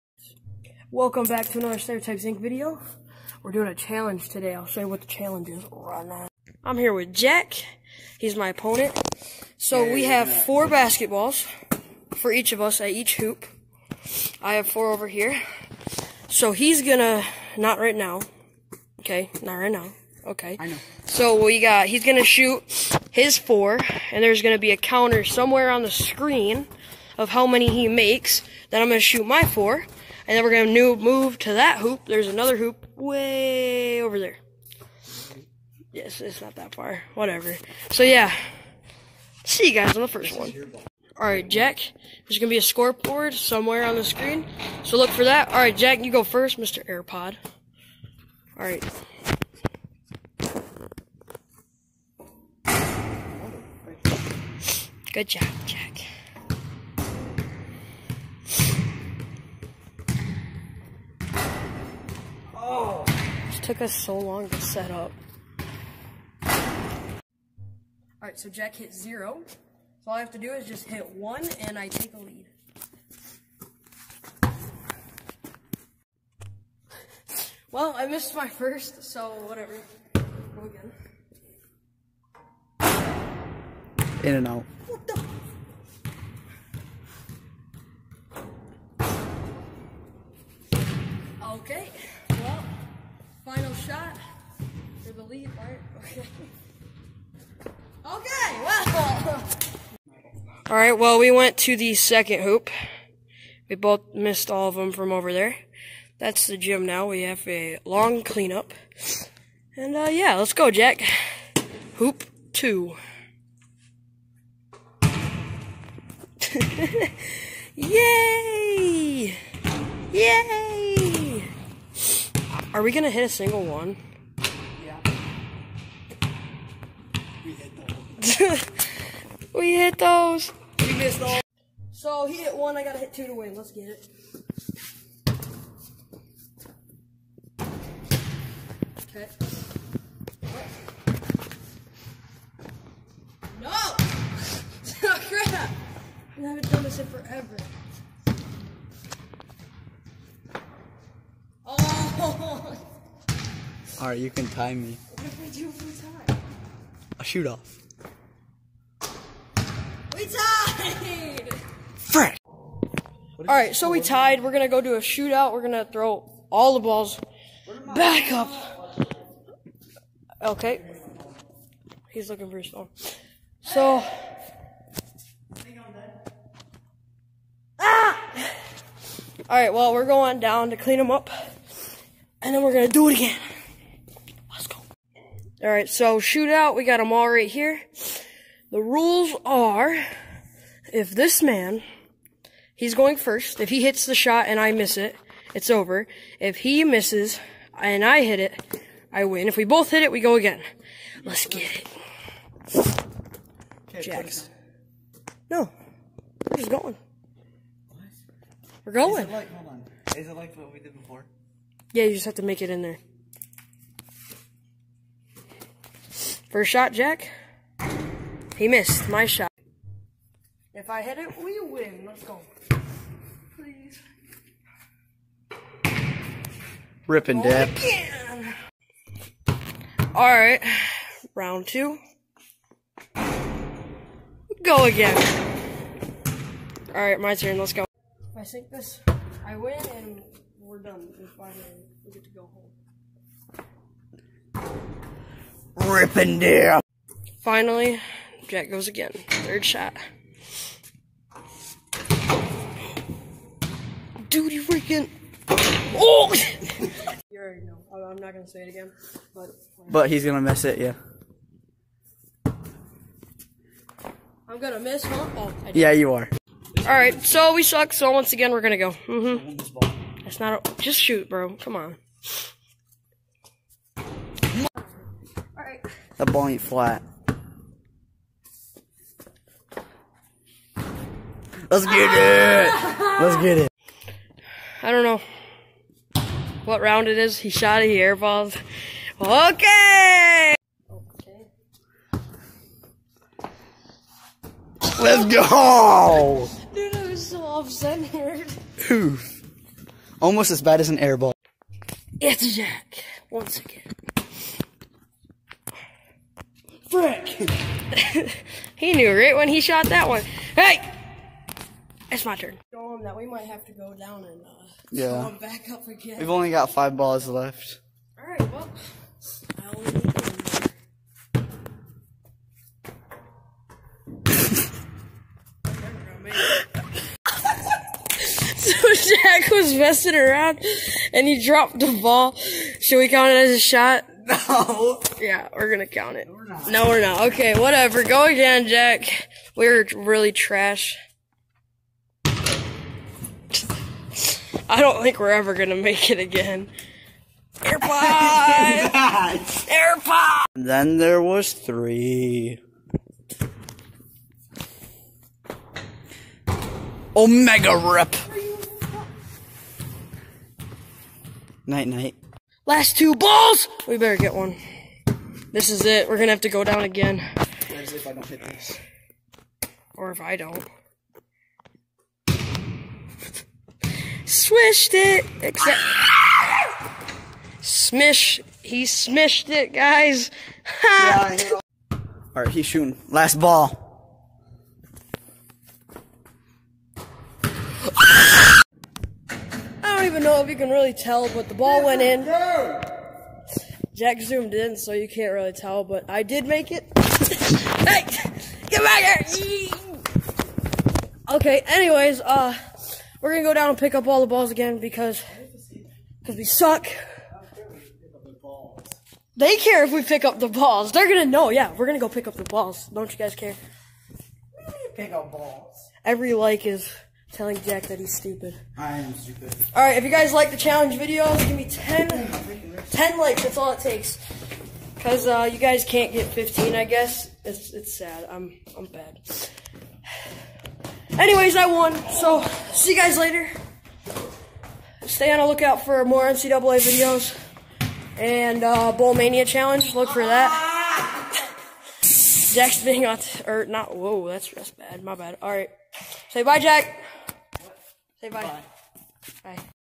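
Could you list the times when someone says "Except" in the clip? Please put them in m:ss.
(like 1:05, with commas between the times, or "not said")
6:15.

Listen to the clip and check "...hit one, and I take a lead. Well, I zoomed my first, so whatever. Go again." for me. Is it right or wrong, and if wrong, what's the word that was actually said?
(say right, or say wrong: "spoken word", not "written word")
wrong: "missed", not "zoomed".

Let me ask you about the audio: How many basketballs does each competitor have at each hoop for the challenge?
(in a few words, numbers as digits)
4.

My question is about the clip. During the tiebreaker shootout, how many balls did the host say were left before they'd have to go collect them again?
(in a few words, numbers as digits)
5.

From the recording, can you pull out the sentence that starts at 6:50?
They're gonna know, yeah, we're gonna go pick up the balls.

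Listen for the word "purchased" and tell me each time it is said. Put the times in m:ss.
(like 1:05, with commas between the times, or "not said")
not said.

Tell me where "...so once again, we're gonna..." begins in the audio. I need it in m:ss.
4:27.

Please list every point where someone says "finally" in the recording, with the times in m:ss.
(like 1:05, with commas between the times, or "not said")
4:01, 4:07.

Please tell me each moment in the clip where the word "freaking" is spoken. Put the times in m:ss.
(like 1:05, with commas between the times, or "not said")
4:14.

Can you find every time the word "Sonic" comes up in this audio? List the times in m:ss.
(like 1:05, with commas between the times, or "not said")
not said.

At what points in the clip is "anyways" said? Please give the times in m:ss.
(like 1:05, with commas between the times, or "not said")
6:41, 7:11.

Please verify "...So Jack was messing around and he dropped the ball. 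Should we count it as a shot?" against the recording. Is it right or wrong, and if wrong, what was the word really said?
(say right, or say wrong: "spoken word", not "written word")
right.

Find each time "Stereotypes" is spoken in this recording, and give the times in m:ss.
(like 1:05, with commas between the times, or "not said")
0:01.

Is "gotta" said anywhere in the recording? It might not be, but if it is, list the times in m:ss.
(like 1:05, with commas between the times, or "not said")
2:12.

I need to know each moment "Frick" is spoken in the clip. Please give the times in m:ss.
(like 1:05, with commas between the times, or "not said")
2:41, 5:06.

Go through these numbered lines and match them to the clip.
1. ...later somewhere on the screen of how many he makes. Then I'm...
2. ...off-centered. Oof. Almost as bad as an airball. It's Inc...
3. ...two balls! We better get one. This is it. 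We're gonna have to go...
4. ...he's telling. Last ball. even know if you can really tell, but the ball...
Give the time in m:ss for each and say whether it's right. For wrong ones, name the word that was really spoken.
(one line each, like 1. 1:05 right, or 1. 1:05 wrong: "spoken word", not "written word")
1. 0:24 wrong: "counter", not "later"
2. 4:57 wrong: "Jack", not "Inc"
3. 6:02 right
4. 6:22 wrong: "shooting", not "telling".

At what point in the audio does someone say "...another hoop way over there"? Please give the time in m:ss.
0:32.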